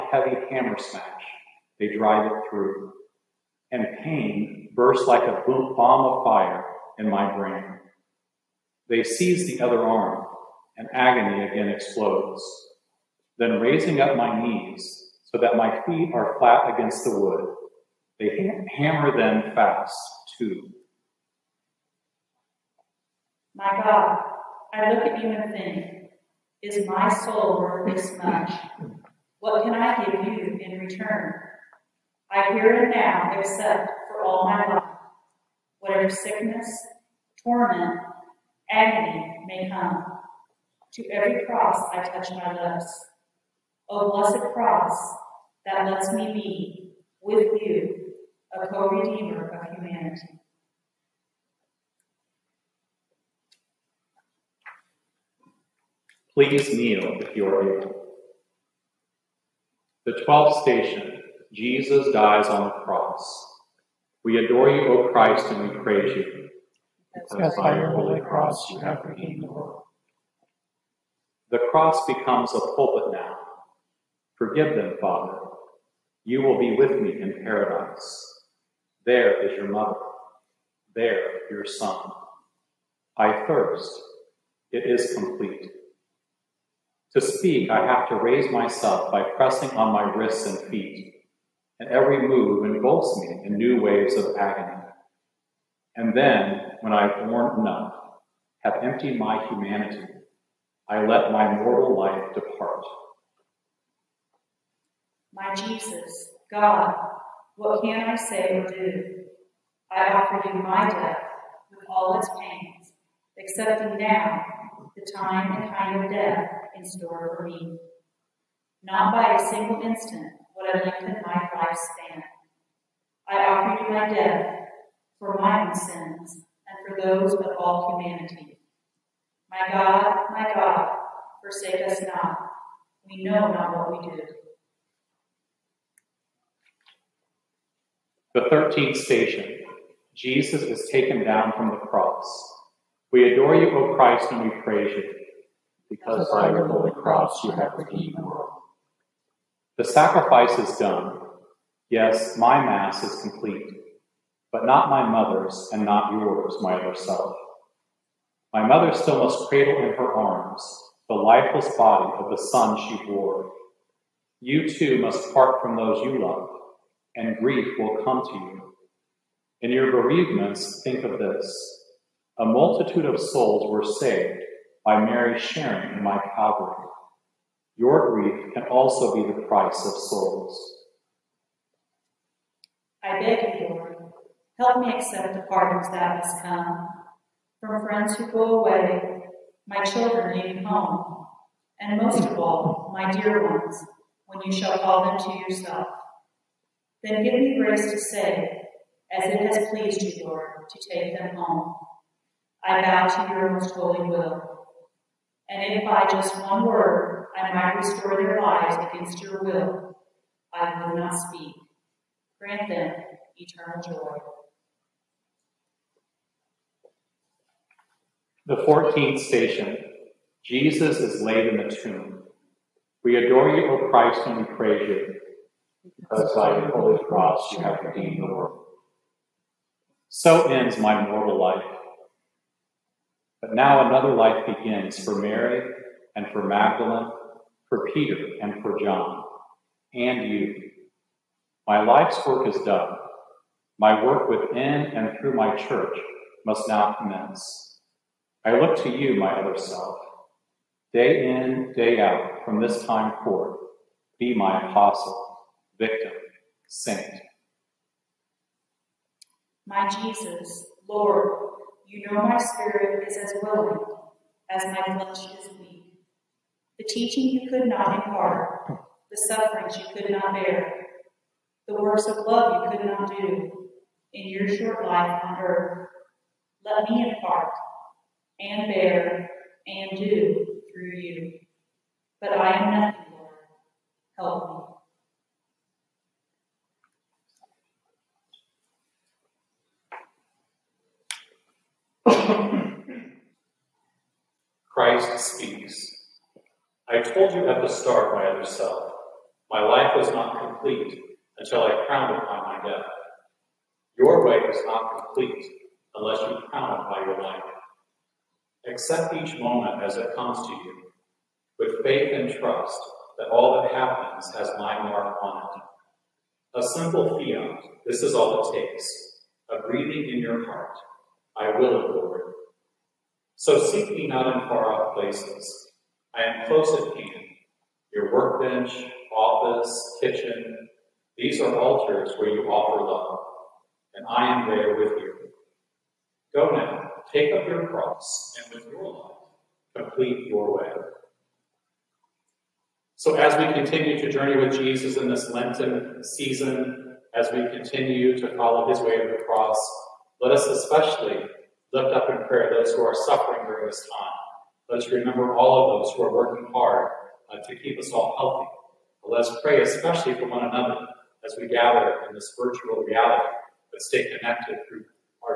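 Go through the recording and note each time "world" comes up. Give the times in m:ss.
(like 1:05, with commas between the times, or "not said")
1:09, 2:28, 3:48.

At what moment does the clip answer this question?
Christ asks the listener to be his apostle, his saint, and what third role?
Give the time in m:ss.
4:15.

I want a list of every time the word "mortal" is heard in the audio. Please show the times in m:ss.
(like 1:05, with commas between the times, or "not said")
1:41, 3:51.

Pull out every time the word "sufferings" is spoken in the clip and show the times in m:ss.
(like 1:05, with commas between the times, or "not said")
4:29, 5:53.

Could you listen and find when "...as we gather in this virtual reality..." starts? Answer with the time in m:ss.
6:01.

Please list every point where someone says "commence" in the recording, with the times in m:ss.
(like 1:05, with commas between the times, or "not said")
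4:06.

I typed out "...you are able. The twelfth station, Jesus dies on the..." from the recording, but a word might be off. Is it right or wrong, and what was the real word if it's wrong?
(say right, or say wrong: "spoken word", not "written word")
right.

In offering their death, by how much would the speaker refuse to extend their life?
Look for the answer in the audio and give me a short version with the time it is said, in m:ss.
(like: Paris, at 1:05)
A single instant, at 1:59.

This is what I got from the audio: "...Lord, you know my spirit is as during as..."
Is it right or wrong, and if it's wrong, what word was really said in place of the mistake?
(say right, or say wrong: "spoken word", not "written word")
wrong: "willing", not "during".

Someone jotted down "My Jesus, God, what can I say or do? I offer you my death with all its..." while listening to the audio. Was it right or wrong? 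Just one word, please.
right.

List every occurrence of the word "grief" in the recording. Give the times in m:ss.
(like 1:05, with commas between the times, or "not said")
2:47, 2:58.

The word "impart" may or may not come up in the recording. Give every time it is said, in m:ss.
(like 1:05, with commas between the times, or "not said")
4:27, 4:37.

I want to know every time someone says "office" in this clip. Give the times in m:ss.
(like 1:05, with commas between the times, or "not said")
5:29.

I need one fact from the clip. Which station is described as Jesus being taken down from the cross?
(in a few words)
13th.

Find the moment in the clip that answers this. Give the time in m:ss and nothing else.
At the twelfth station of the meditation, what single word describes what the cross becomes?
1:12.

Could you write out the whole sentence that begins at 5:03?
Your way is not complete unless you crown it by your life.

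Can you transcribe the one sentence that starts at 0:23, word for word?
My God, I look at you and think, is my soul worth this much?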